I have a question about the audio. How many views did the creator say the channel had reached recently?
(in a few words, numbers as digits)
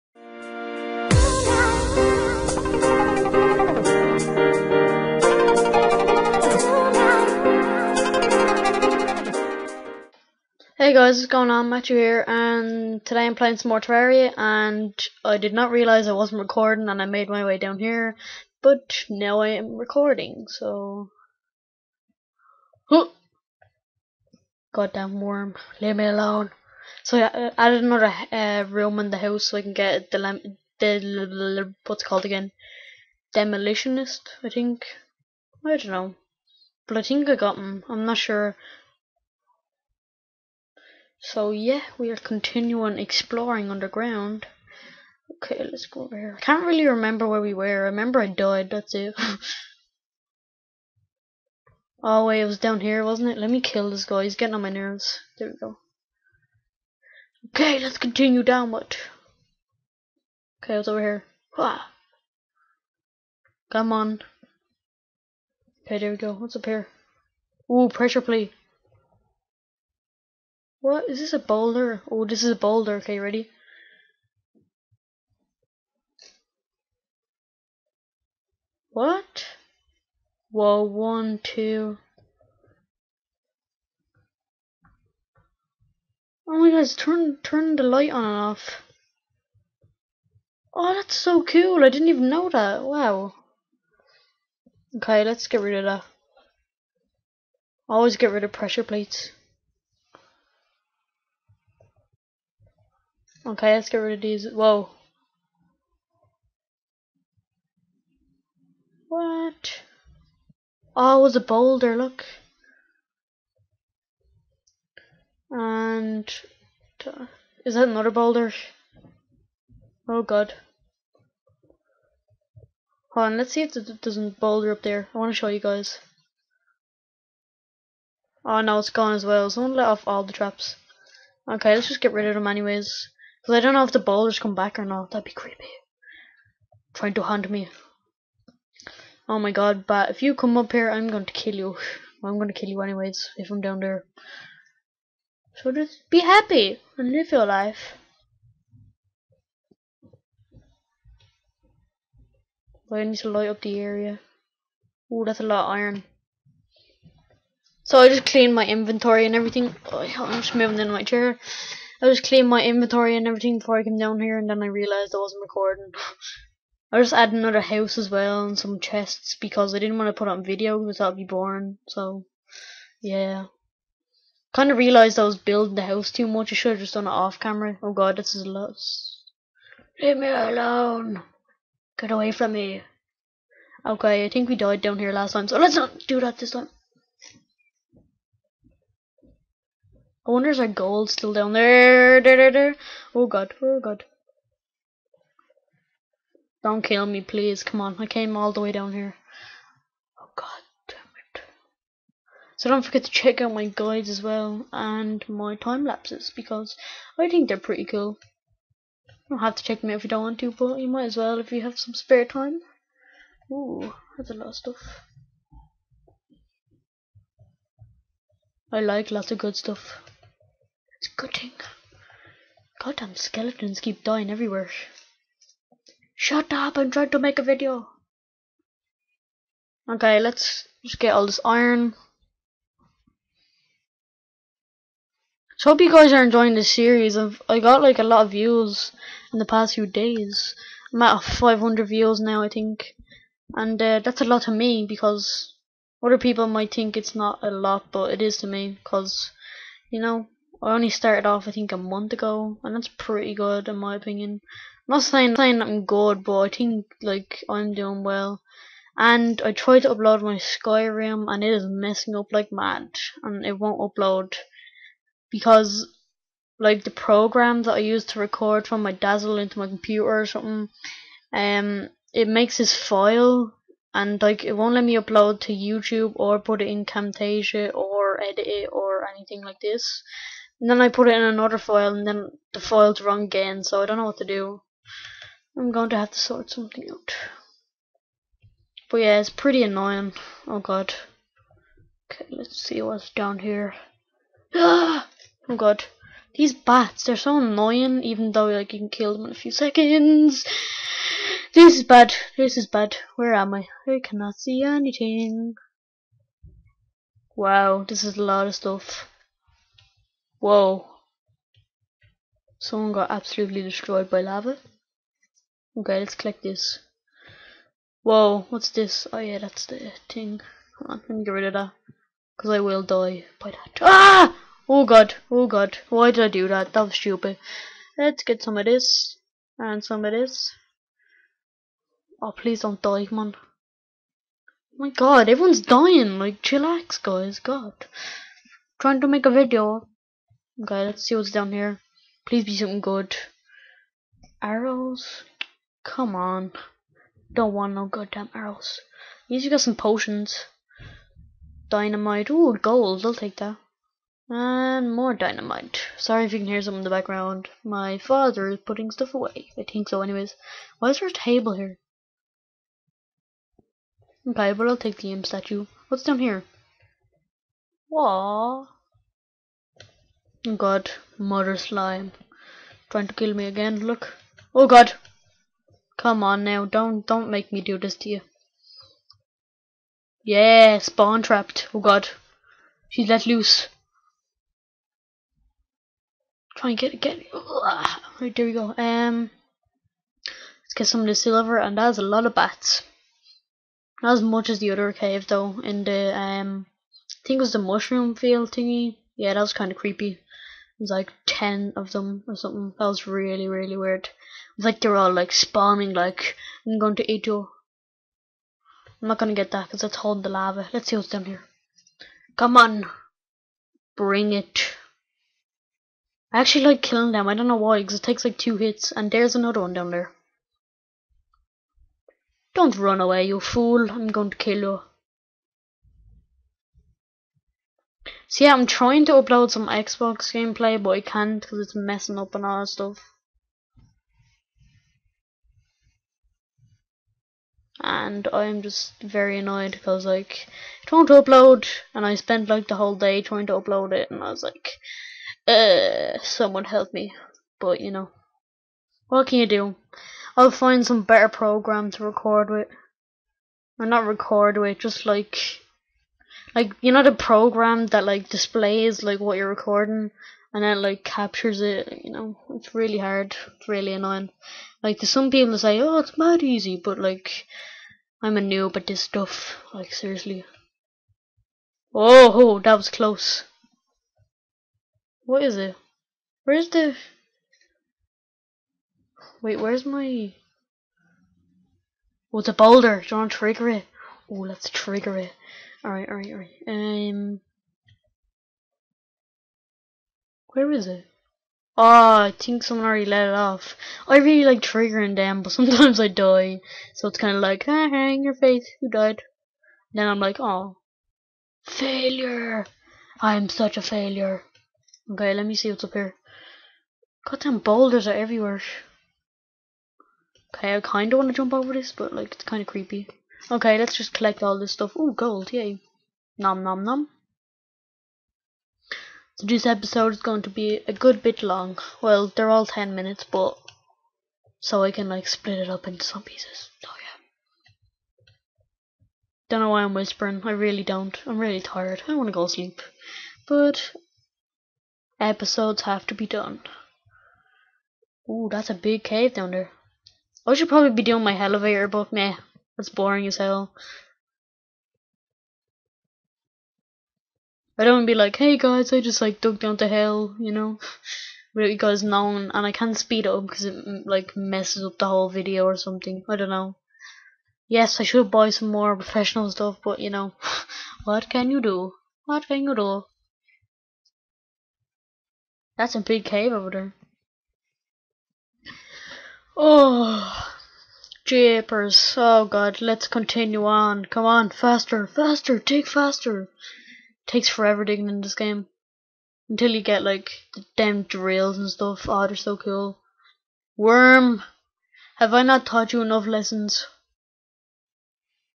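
500.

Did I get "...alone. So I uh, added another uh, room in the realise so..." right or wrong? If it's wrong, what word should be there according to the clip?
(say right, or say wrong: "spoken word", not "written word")
wrong: "house", not "realise".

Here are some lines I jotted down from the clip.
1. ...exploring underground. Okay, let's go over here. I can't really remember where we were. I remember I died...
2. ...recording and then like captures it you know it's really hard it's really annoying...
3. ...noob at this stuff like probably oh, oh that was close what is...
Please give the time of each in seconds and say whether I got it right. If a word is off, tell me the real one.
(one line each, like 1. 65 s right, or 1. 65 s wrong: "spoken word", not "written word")
1. 42 s right
2. 459 s right
3. 468 s wrong: "seriously", not "probably".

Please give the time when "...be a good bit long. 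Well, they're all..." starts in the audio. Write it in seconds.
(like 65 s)
520 s.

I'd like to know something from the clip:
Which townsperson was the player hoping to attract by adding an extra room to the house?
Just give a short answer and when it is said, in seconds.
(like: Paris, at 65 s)
Demolitionist, at 33 s.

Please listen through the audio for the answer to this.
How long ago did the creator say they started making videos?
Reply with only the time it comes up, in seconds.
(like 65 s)
251 s.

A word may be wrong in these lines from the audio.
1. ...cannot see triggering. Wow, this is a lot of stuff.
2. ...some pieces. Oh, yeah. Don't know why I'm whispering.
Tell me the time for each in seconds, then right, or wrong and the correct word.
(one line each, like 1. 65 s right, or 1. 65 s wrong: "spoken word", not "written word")
1. 304 s wrong: "anything", not "triggering"
2. 526 s right.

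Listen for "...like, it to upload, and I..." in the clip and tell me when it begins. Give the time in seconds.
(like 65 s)
440 s.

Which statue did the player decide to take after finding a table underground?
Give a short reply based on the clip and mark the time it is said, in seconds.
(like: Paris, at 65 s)
imp statue, at 365 s.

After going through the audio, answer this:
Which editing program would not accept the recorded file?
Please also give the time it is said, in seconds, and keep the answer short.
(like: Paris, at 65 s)
Camtasia, at 276 s.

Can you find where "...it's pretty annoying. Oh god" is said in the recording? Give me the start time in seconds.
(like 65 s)
289 s.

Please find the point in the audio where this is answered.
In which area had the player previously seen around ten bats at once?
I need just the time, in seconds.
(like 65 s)
397 s.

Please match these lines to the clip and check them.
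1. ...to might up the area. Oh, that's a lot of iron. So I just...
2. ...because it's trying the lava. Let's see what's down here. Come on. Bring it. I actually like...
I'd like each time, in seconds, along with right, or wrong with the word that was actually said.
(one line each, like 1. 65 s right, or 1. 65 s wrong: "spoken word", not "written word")
1. 153 s wrong: "light", not "might"
2. 409 s wrong: "holding", not "trying".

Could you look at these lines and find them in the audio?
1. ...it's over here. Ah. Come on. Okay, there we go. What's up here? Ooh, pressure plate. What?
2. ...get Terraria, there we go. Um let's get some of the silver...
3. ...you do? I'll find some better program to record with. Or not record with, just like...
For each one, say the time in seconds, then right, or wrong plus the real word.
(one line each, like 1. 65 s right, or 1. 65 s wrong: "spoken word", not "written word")
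1. 60 s right
2. 387 s wrong: "Right", not "Terraria"
3. 449 s right.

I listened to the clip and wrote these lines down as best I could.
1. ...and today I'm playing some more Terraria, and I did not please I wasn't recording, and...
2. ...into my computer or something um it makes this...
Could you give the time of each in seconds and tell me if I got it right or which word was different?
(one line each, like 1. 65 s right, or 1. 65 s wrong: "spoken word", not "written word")
1. 12 s wrong: "realise", not "please"
2. 269 s right.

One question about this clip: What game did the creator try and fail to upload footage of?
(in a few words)
Skyrim.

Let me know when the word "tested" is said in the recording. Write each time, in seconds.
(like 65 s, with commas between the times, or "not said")
not said.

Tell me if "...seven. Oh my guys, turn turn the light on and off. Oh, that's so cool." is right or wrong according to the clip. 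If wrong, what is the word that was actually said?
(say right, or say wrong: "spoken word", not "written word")
wrong: "two", not "seven".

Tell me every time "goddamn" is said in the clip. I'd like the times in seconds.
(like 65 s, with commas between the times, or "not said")
24 s, 222 s, 347 s, 507 s.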